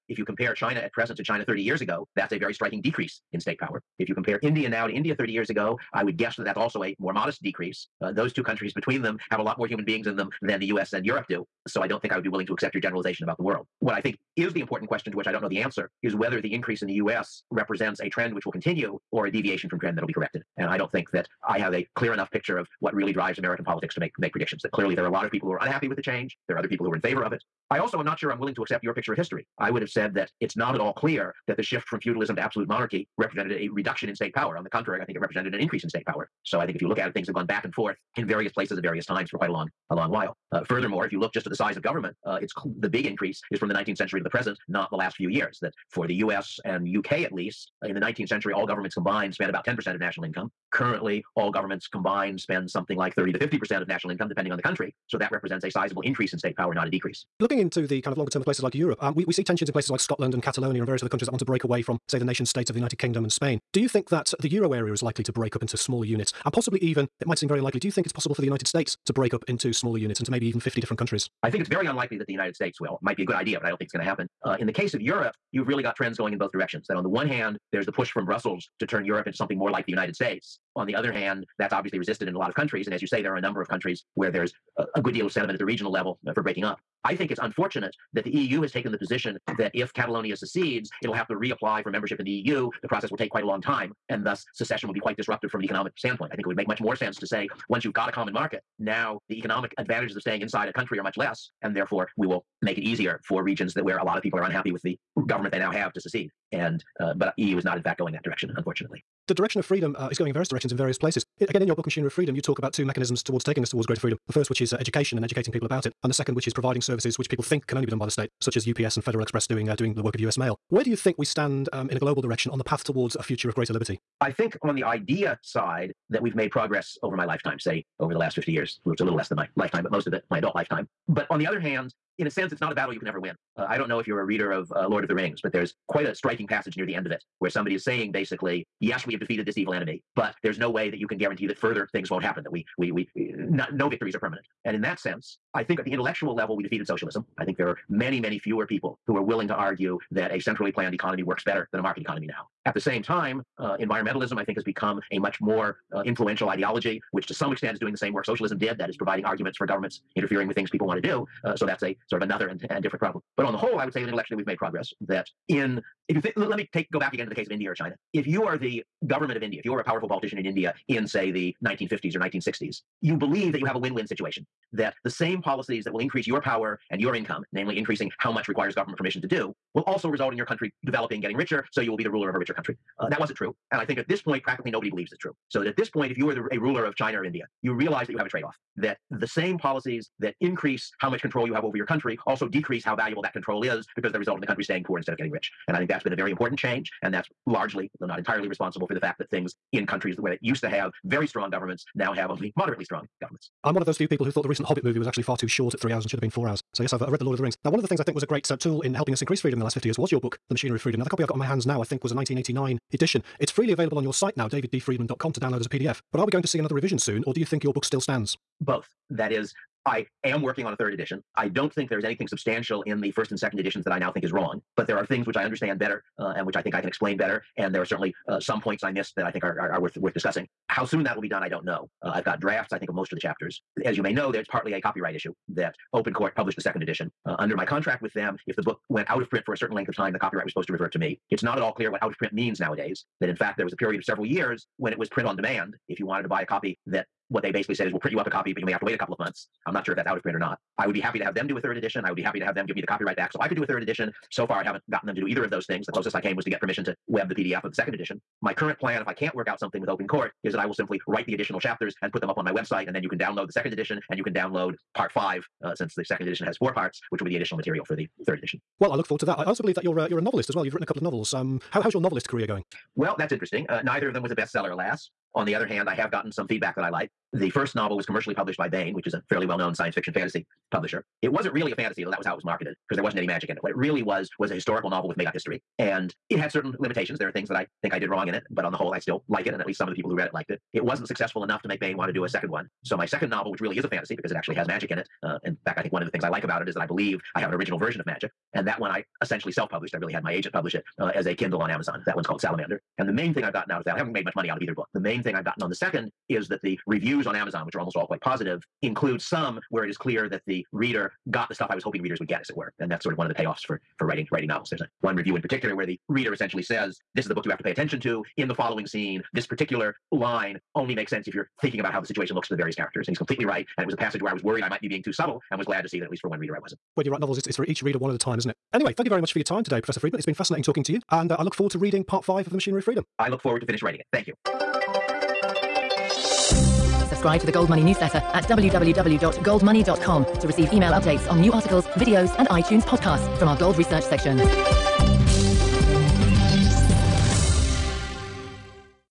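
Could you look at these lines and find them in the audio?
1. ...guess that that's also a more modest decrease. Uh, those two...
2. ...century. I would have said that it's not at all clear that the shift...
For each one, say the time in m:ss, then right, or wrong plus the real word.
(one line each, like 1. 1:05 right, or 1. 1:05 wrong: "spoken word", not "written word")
1. 0:06 right
2. 0:29 wrong: "history", not "century".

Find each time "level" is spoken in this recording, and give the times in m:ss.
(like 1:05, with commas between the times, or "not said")
1:25, 2:26.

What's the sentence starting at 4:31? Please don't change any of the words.
Um, how, how's your novelist career going?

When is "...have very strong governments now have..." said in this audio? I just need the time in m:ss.
3:20.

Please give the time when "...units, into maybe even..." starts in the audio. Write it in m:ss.
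1:09.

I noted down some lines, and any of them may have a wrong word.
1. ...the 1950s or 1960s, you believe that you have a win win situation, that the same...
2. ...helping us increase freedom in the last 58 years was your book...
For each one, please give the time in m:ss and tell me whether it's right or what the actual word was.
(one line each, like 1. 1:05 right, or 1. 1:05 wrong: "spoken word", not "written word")
1. 2:51 right
2. 3:28 wrong: "50", not "58".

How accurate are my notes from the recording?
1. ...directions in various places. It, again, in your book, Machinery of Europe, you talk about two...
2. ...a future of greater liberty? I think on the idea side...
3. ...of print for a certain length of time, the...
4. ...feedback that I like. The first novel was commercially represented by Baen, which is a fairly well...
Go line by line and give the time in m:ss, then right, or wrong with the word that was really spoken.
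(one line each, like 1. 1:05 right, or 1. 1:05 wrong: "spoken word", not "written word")
1. 1:50 wrong: "Freedom", not "Europe"
2. 2:03 right
3. 3:59 right
4. 4:36 wrong: "published", not "represented".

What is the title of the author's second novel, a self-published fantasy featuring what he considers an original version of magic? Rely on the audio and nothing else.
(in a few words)
Salamander.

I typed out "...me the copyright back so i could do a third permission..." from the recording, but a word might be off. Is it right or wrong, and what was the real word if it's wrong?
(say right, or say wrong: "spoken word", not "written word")
wrong: "edition", not "permission".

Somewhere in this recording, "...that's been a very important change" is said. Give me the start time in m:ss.
3:15.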